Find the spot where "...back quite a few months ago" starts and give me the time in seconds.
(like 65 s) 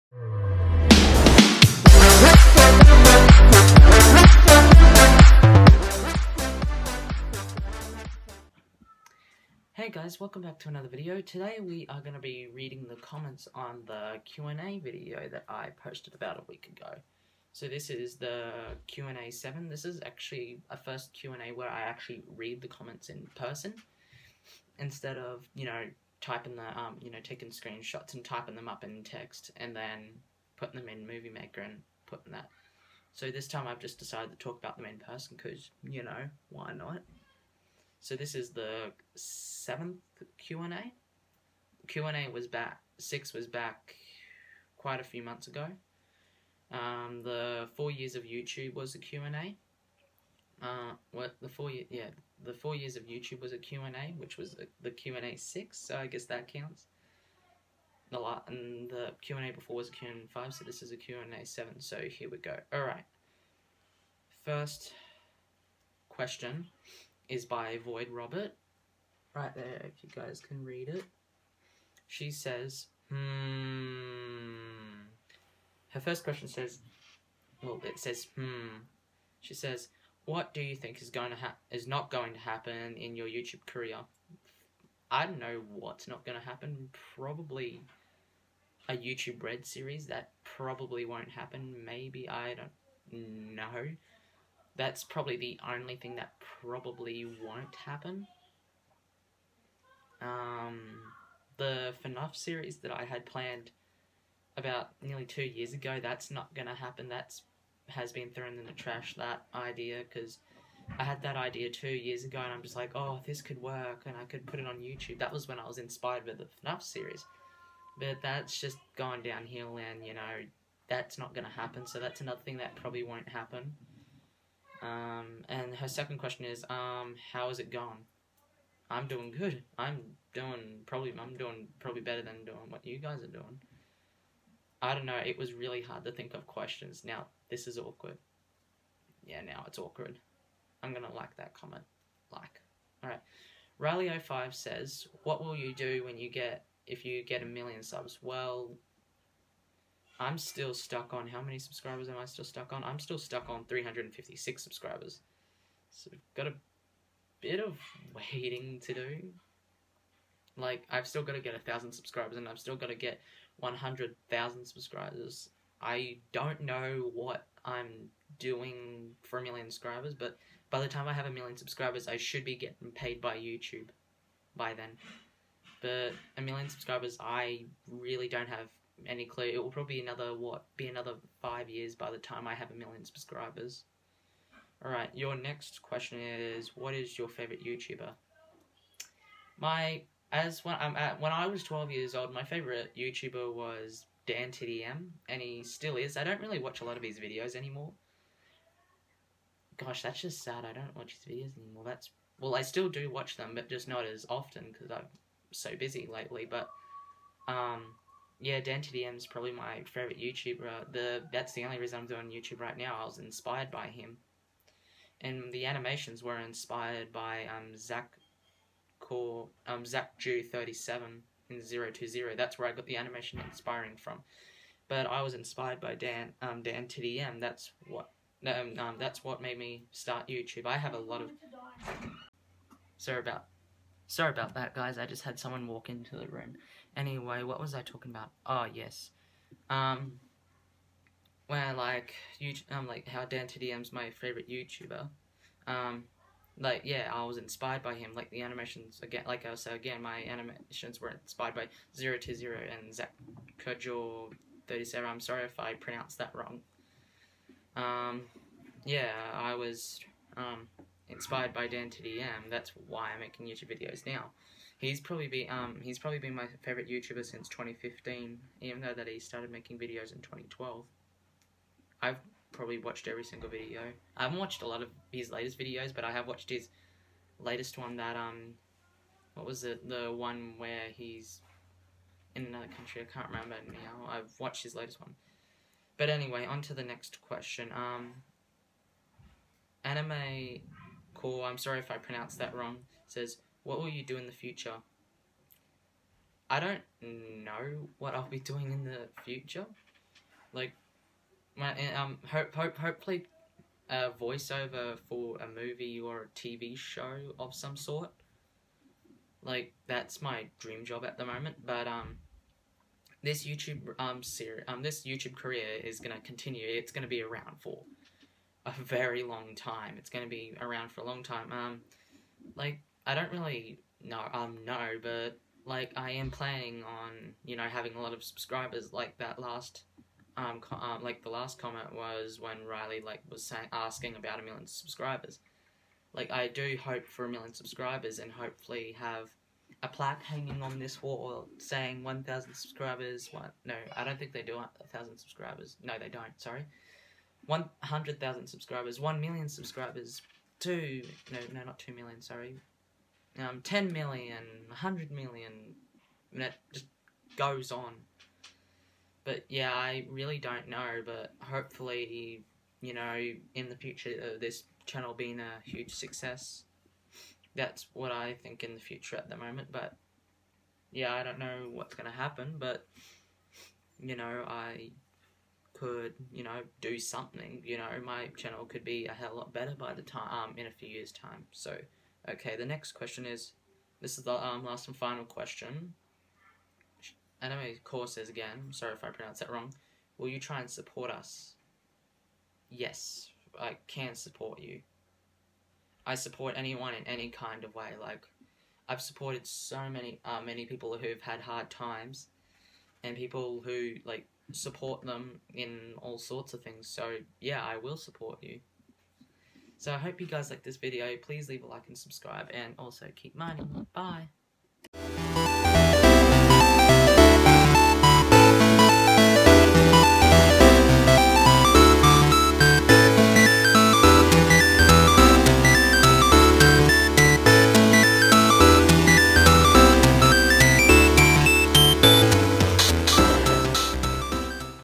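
43 s.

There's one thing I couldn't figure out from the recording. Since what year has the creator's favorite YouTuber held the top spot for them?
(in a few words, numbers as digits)
2015.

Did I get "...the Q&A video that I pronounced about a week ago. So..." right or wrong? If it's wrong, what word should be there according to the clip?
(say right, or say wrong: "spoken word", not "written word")
wrong: "posted", not "pronounced".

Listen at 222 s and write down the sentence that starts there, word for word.
That's where I got the animation inspiring from.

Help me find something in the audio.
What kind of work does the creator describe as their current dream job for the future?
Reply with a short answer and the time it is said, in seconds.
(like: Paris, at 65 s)
voiceover, at 303 s.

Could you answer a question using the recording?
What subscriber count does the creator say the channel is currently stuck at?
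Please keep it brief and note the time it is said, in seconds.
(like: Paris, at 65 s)
356, at 153 s.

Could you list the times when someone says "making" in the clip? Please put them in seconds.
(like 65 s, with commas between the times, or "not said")
263 s, 269 s.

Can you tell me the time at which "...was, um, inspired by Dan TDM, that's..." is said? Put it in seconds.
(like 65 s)
259 s.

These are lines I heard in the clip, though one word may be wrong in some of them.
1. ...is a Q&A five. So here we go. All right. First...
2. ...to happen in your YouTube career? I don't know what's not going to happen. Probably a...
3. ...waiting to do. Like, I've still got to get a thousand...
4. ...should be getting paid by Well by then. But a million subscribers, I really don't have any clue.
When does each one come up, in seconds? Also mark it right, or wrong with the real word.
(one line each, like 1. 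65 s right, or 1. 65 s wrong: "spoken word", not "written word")
1. 60 s wrong: "seven", not "five"
2. 82 s right
3. 158 s right
4. 172 s wrong: "YouTube", not "Well".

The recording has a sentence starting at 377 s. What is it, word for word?
You know, my channel could be a hell lot better by the time, um, in a few years' time.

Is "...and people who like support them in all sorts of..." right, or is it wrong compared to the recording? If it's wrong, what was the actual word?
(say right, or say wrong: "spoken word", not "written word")
right.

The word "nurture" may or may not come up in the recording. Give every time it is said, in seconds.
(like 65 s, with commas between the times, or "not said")
not said.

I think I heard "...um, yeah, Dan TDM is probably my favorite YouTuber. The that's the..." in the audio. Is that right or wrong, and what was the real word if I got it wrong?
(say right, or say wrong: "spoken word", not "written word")
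right.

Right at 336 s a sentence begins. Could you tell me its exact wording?
Like I do hope for a million subscribers and hopefully have a plaque hanging on this wall saying 1,000 subscribers.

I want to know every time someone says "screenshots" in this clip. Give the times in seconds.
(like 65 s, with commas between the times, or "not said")
27 s.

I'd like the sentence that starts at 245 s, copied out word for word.
Um, like, yeah, I was inspired by him.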